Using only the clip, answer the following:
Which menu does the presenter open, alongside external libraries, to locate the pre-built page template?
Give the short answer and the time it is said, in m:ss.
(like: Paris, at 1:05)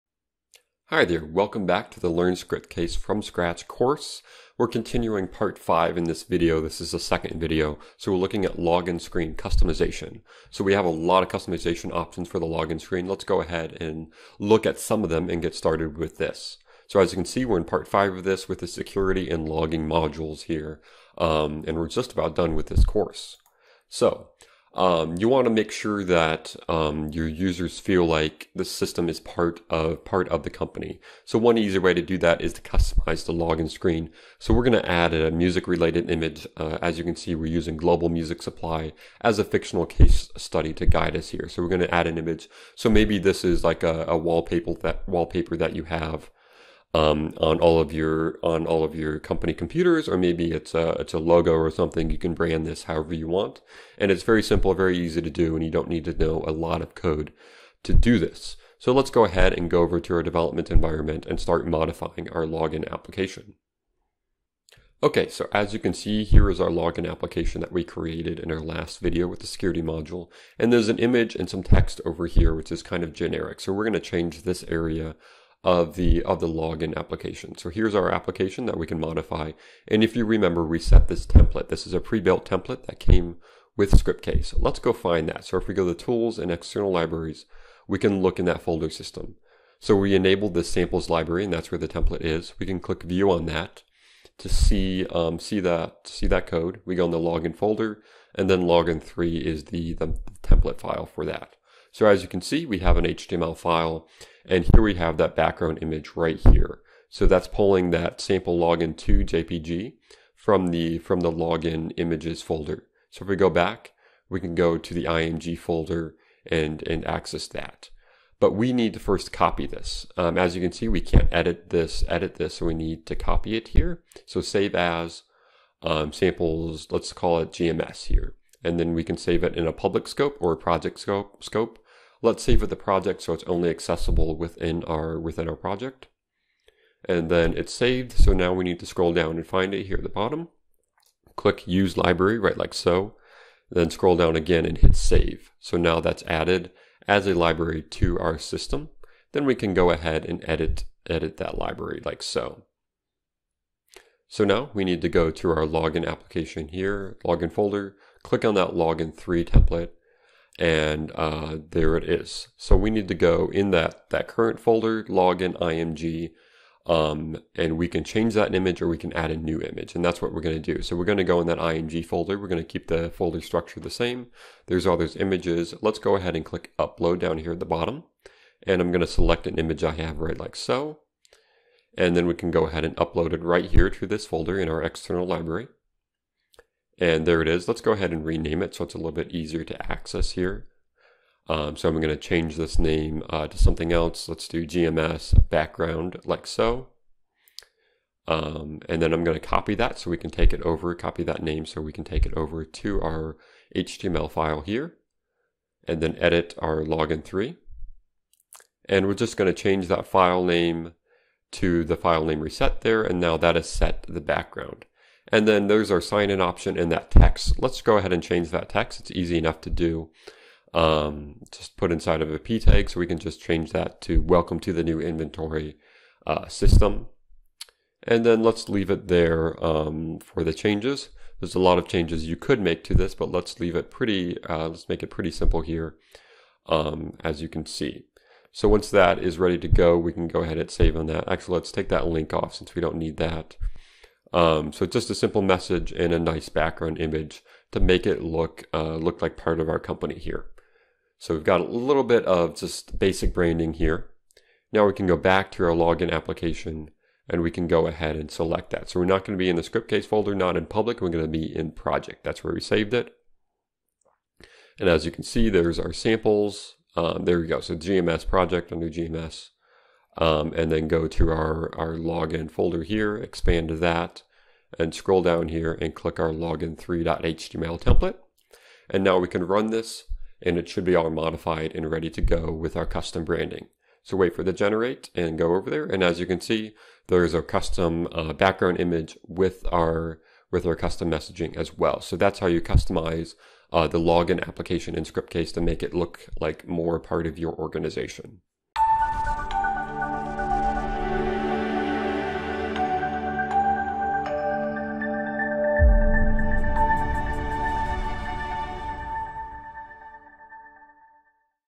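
Tools, at 1:25.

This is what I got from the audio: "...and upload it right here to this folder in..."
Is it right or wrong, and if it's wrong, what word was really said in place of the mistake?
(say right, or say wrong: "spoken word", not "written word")
right.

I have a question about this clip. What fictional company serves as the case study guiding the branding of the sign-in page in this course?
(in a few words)
Global Music Supply.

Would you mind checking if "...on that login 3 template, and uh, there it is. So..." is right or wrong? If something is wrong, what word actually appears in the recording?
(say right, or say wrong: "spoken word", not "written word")
right.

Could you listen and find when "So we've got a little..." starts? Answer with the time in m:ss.
4:11.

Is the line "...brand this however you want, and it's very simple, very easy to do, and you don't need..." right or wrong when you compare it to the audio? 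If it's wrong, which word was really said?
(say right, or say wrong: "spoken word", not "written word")
right.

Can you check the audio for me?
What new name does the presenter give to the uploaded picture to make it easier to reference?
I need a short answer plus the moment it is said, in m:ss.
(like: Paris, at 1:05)
GMS background, at 3:14.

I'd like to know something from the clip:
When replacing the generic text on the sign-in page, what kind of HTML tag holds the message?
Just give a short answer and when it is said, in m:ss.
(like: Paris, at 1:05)
p tag, at 3:42.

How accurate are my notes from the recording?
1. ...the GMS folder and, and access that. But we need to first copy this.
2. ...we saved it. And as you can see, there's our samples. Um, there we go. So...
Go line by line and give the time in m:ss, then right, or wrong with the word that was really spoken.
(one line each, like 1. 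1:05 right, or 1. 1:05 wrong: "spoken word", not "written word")
1. 1:54 wrong: "IMG", not "GMS"
2. 4:22 right.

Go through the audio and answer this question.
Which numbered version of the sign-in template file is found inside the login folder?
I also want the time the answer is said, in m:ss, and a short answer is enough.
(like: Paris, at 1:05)
login three, at 1:38.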